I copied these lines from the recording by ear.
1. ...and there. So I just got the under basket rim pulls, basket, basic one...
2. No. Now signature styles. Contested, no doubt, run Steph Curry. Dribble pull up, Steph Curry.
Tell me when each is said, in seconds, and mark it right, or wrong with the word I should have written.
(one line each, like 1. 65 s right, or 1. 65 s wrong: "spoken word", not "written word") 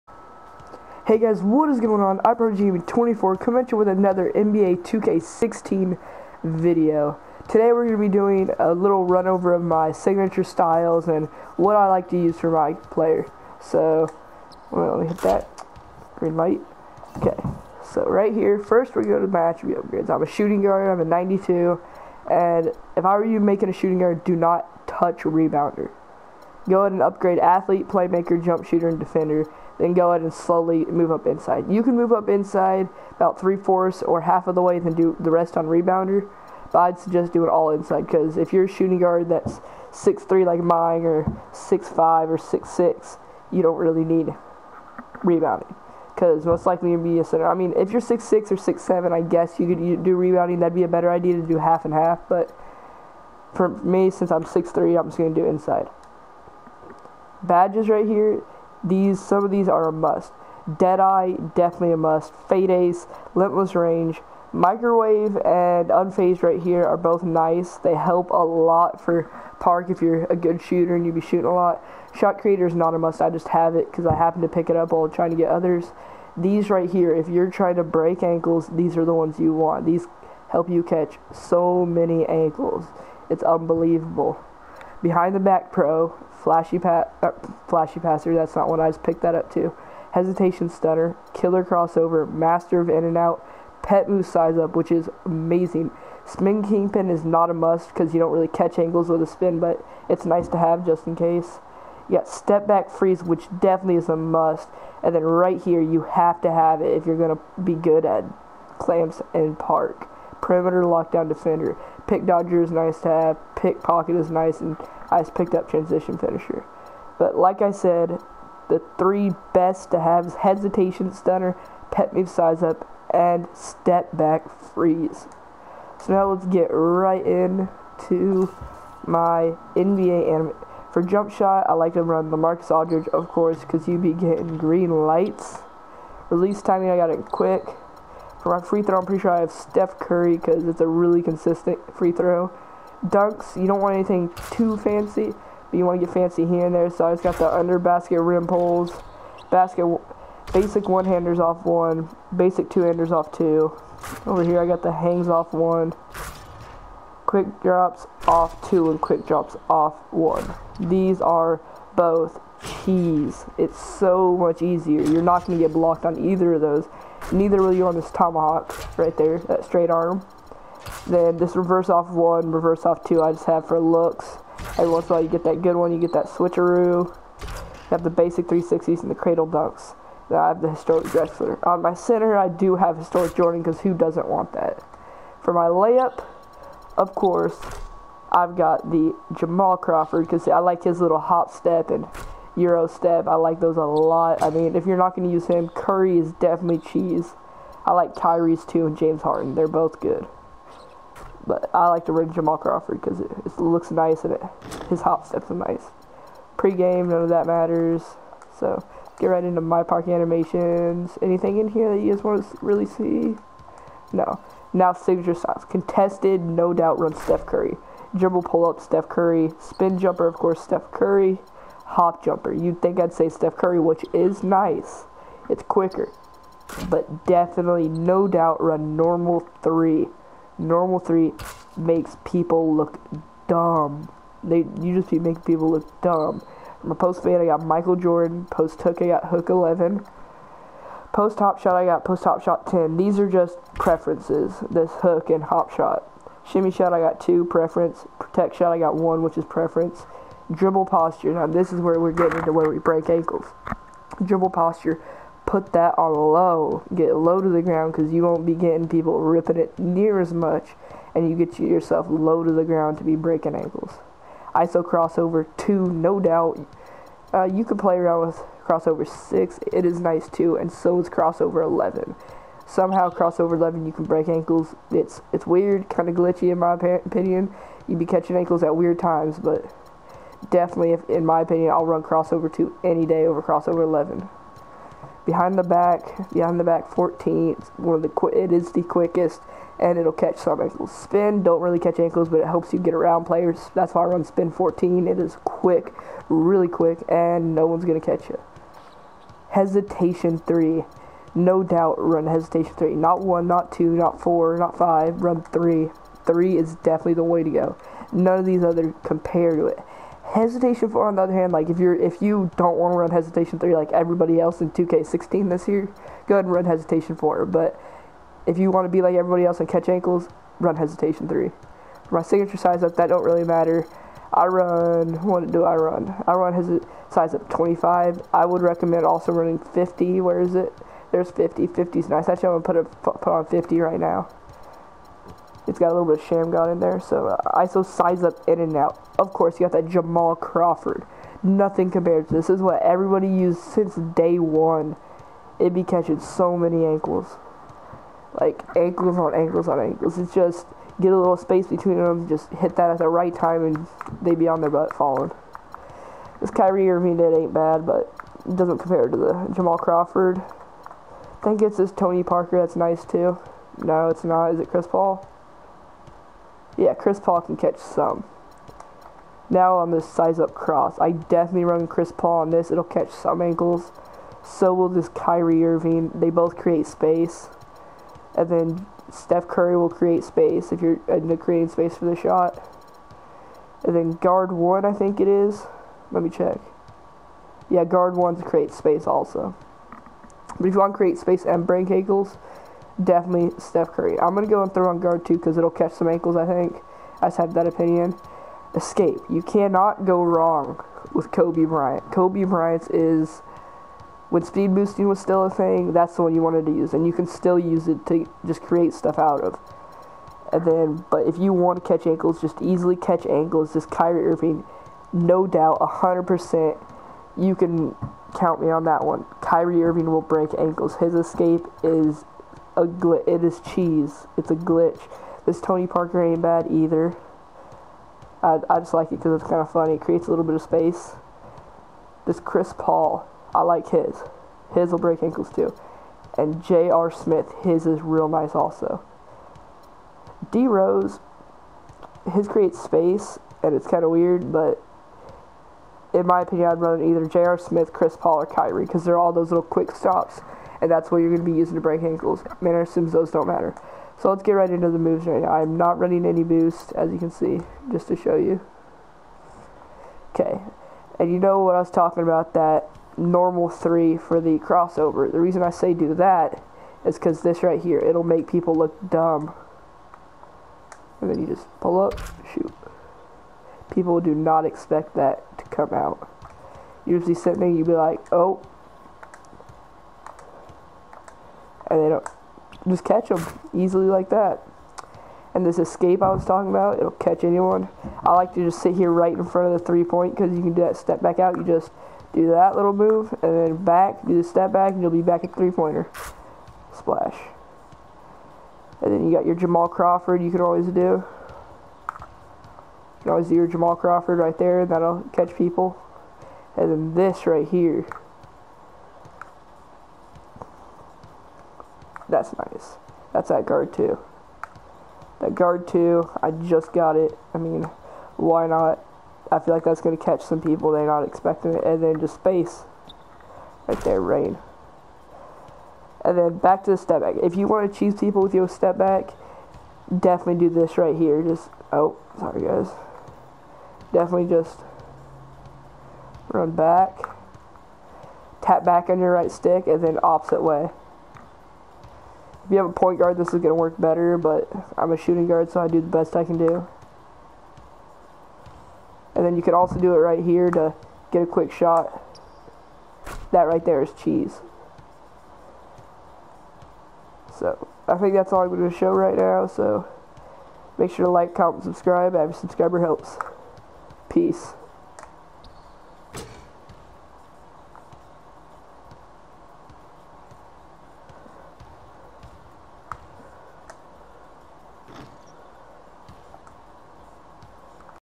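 1. 146 s right
2. 214 s right.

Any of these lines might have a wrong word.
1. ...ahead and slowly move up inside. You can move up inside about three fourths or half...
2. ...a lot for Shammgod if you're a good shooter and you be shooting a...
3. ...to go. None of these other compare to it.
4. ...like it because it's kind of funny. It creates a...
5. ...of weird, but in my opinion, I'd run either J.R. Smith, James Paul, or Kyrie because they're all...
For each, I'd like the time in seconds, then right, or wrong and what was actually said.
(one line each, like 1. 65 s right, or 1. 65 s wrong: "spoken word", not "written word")
1. 30 s right
2. 68 s wrong: "Park", not "Shammgod"
3. 307 s right
4. 428 s right
5. 444 s wrong: "Chris", not "James".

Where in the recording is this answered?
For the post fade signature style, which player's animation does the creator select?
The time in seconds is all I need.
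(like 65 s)
237 s.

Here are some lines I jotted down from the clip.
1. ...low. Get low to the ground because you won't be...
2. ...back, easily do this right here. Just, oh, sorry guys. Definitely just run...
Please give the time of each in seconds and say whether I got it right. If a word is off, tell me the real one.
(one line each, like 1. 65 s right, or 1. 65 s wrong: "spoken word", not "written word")
1. 256 s right
2. 528 s wrong: "definitely", not "easily".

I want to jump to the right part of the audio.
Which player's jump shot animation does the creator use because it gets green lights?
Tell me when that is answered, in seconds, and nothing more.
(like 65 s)
132 s.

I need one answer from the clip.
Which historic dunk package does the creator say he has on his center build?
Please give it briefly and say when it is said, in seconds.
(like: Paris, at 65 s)
Historic Jordan, at 182 s.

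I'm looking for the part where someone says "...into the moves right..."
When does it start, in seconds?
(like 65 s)
454 s.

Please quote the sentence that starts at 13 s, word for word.
So, well, let me hit that green light.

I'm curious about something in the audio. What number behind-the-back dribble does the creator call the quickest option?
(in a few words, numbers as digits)
14.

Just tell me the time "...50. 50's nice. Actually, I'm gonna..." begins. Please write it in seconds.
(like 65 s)
331 s.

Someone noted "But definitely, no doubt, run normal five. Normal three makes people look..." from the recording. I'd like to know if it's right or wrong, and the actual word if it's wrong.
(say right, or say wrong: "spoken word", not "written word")
wrong: "three", not "five".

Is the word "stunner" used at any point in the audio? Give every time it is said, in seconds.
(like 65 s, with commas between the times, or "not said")
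90 s, 121 s.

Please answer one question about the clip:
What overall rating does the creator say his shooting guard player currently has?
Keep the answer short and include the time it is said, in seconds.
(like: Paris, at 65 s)
92, at 21 s.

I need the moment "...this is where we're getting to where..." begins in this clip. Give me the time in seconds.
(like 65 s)
251 s.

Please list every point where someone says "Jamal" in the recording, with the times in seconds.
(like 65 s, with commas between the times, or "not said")
189 s, 202 s, 339 s, 359 s, 499 s, 503 s.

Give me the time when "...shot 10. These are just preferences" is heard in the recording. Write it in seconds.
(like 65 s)
242 s.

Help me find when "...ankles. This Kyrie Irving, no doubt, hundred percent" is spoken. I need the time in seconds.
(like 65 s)
413 s.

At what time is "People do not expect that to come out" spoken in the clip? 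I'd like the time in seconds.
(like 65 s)
473 s.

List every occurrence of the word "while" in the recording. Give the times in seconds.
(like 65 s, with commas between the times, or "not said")
74 s, 175 s.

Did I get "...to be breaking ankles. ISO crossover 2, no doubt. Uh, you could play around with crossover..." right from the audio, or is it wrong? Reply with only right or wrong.
right.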